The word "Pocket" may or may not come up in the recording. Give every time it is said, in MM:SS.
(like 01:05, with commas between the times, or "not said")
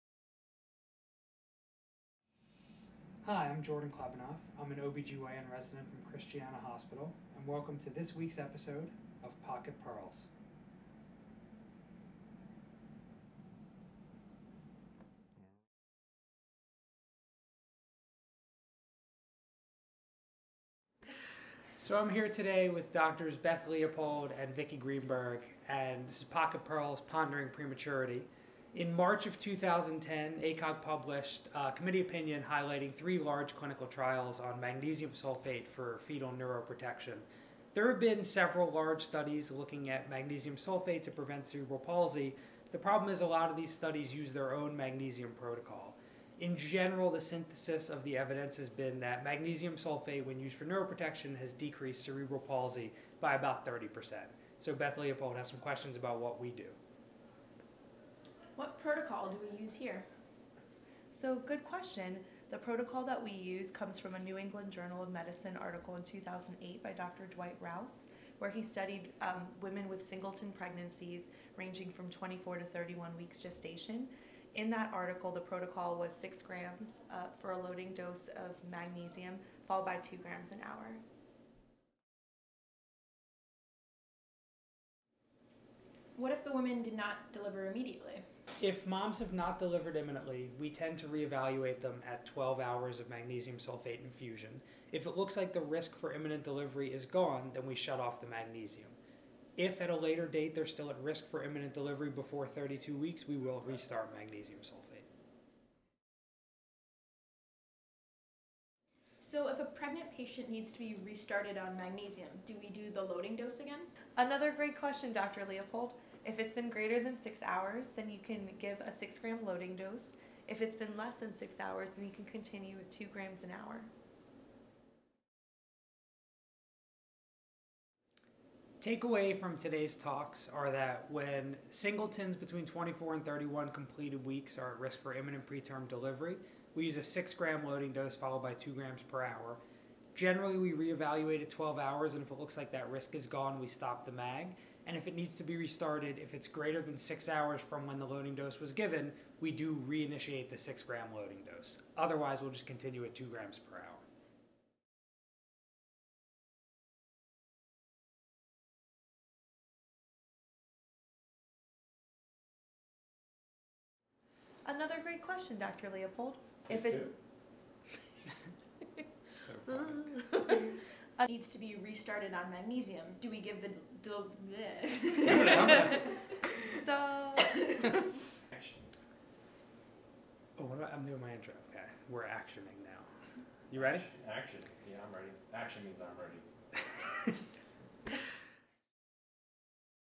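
00:09, 00:26.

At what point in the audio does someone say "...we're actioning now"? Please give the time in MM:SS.
03:02.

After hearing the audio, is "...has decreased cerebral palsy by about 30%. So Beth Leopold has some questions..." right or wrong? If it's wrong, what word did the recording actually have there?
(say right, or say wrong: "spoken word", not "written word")
right.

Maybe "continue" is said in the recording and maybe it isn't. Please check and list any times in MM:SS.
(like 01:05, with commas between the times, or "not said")
02:02, 02:32.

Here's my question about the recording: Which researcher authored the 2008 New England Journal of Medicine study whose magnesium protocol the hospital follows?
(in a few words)
Dwight Rouse.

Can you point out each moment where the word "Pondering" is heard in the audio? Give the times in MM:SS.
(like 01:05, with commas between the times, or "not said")
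00:27.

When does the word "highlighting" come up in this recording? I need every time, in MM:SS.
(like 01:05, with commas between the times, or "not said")
00:32.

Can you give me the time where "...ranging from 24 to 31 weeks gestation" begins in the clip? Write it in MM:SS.
01:11.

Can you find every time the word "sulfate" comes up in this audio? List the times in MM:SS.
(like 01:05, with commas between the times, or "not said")
00:35, 00:40, 00:49, 01:33, 01:44.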